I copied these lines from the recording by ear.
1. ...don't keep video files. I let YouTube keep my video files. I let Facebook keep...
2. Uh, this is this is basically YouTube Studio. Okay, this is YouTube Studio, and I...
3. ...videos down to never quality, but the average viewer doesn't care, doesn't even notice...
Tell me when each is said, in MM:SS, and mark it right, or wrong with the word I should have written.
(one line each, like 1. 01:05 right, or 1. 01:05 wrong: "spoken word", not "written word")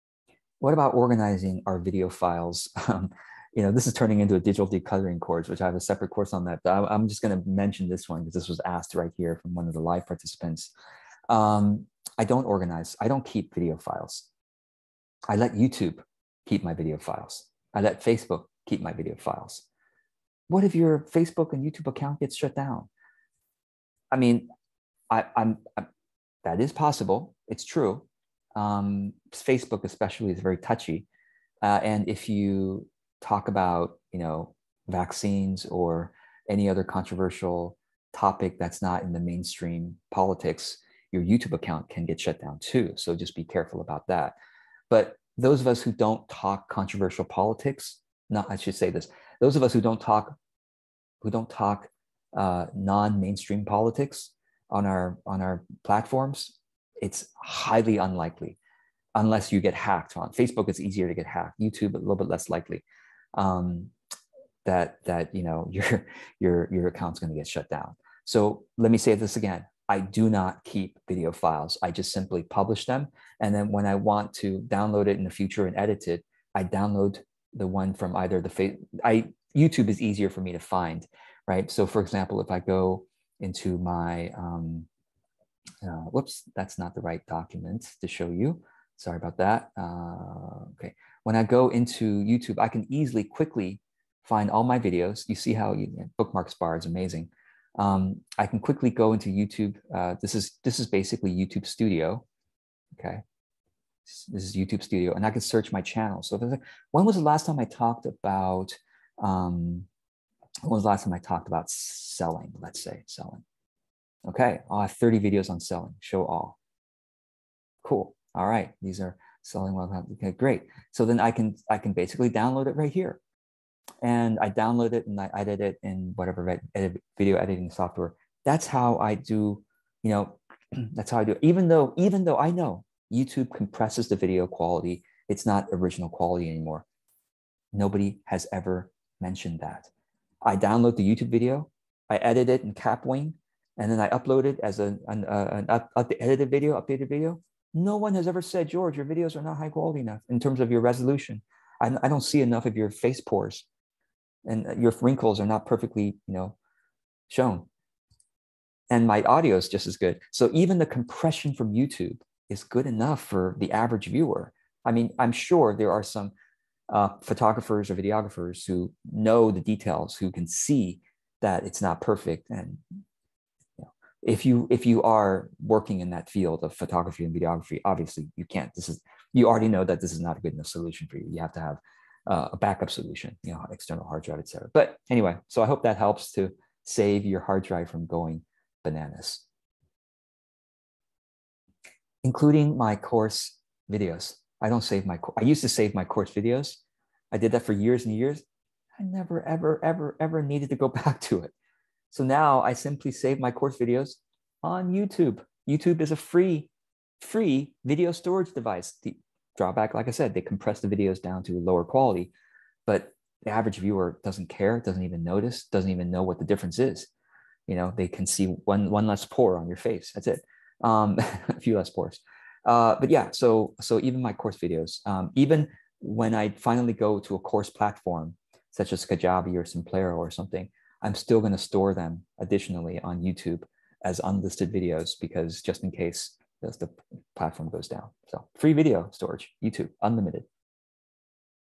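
1. 00:13 right
2. 01:39 right
3. 03:30 wrong: "lower", not "never".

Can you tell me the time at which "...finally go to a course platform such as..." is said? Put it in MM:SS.
03:46.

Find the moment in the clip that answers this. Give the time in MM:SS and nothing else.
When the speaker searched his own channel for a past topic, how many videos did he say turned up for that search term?
01:54.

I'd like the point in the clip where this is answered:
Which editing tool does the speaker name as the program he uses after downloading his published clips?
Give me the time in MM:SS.
02:22.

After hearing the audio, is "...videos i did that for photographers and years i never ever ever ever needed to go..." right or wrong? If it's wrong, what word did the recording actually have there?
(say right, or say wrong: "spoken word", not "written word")
wrong: "years", not "photographers".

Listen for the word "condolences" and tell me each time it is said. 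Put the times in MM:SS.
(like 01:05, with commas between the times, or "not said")
not said.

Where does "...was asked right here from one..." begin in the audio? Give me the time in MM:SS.
00:08.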